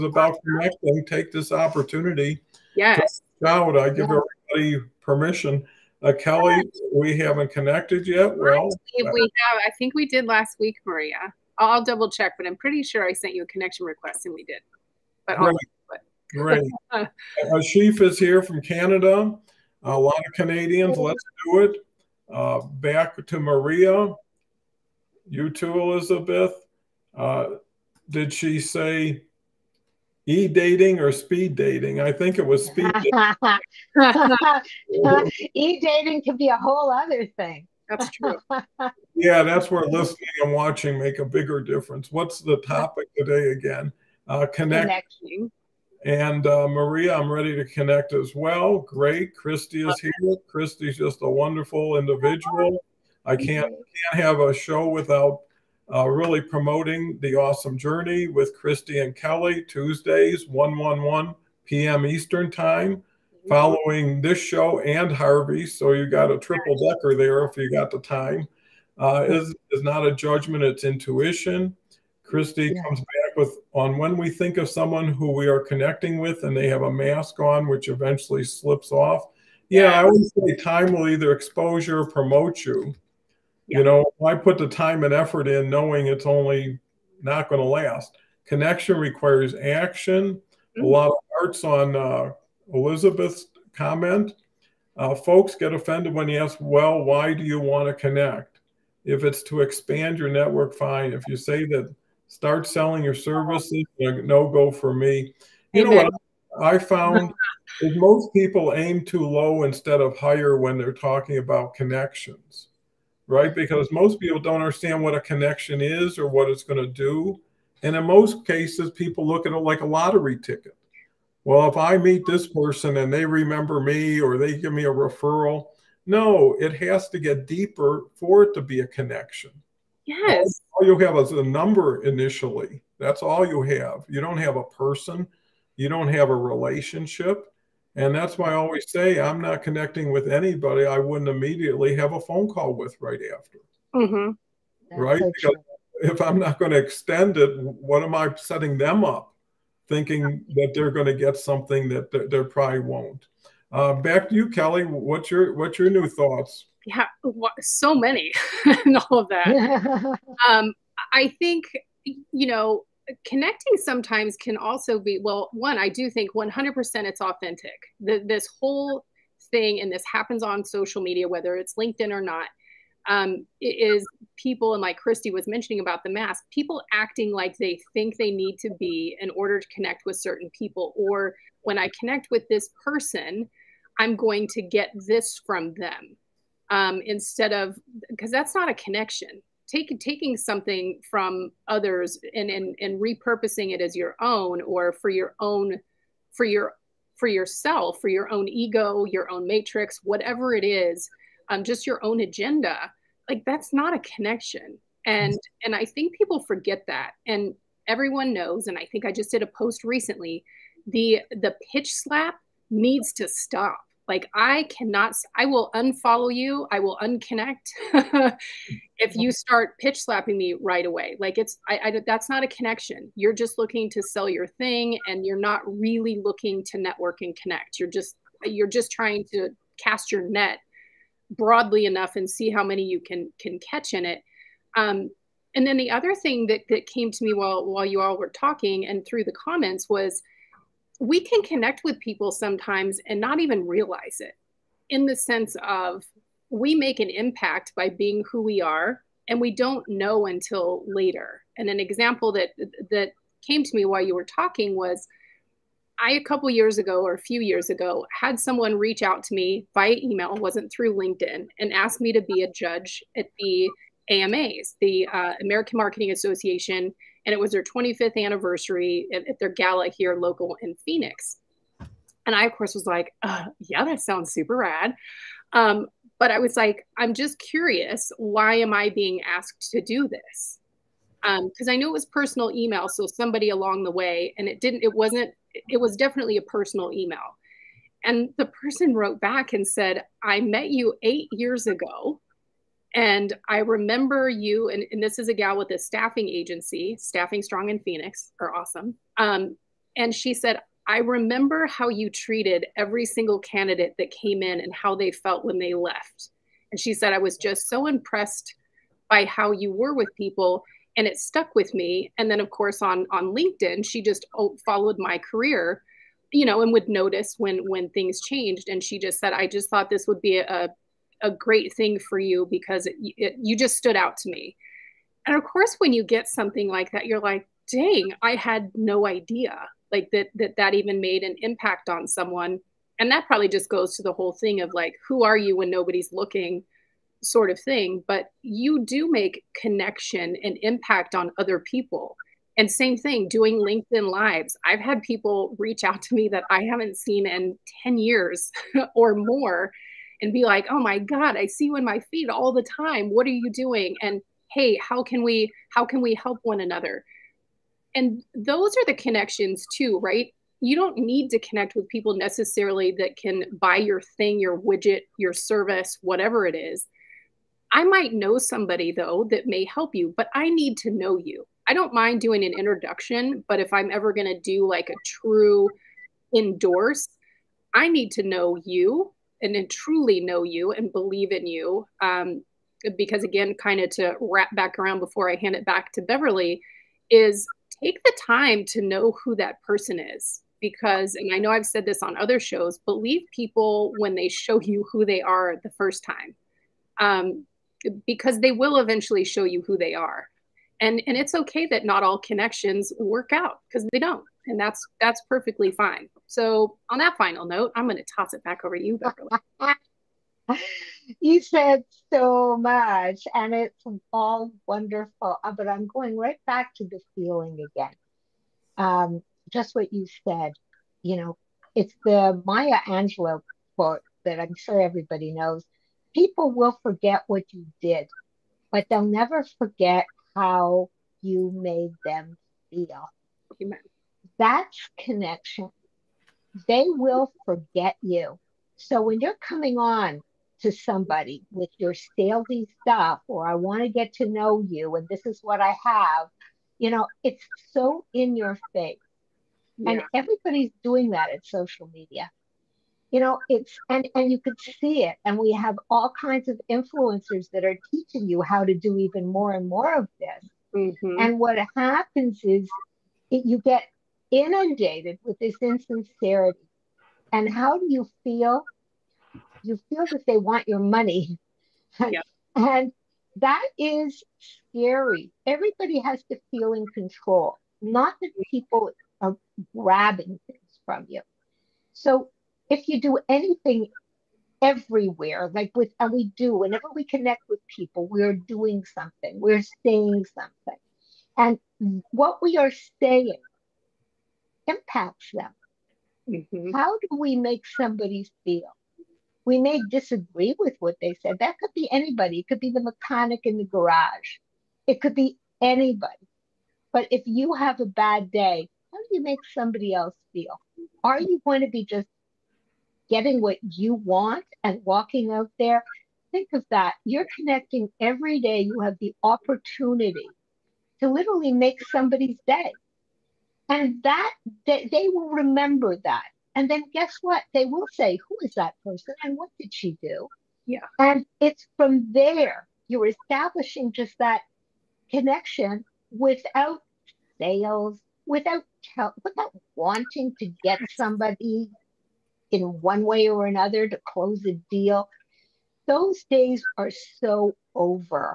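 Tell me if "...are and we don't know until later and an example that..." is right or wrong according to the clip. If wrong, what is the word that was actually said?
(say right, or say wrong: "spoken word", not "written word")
right.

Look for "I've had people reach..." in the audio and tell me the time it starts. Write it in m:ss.
5:44.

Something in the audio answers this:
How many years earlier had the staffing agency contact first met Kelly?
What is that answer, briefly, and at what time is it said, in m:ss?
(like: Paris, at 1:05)
8, at 4:51.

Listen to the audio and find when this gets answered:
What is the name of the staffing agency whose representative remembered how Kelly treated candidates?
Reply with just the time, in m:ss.
4:56.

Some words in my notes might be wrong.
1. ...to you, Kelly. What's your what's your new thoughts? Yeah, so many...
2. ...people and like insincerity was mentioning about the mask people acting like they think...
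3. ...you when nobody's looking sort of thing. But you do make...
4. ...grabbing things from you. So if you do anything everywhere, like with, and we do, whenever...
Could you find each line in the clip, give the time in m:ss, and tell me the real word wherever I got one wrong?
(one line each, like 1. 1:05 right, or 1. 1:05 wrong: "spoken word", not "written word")
1. 2:34 right
2. 2:54 wrong: "christy", not "insincerity"
3. 5:35 right
4. 7:59 right.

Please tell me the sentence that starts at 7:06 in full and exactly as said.
People will forget what you did, but they'll never forget how you made them feel.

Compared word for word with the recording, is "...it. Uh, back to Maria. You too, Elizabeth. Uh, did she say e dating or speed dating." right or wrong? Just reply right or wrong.
right.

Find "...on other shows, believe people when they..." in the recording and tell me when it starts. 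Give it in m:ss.
6:32.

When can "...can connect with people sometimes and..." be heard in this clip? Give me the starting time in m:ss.
4:01.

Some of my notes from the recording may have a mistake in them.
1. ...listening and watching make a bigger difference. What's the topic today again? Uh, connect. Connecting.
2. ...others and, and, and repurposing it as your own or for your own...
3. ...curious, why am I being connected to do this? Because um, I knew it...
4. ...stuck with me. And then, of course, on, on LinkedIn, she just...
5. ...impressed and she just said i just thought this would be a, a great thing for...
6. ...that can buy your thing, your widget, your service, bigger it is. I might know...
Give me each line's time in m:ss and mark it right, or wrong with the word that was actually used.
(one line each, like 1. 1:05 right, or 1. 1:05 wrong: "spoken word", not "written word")
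1. 0:39 right
2. 3:11 right
3. 4:37 wrong: "asked", not "connected"
4. 5:11 right
5. 5:18 wrong: "changed", not "impressed"
6. 6:02 wrong: "whatever", not "bigger".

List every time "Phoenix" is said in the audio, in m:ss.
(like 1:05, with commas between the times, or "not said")
4:30, 4:57.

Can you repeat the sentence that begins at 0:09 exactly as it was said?
I think we did last week, Maria.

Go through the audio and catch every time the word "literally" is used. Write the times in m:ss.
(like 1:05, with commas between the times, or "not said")
8:41.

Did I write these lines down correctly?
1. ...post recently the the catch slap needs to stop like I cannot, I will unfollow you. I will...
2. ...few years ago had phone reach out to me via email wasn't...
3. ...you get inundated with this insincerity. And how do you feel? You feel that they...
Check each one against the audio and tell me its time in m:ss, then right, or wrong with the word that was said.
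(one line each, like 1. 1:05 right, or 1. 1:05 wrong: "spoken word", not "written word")
1. 3:29 wrong: "pitch", not "catch"
2. 4:17 wrong: "someone", not "phone"
3. 7:43 right.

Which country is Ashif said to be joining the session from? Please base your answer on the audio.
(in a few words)
Canada.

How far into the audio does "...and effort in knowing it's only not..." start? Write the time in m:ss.
1:25.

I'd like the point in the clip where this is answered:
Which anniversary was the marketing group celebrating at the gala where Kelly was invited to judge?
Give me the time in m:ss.
4:27.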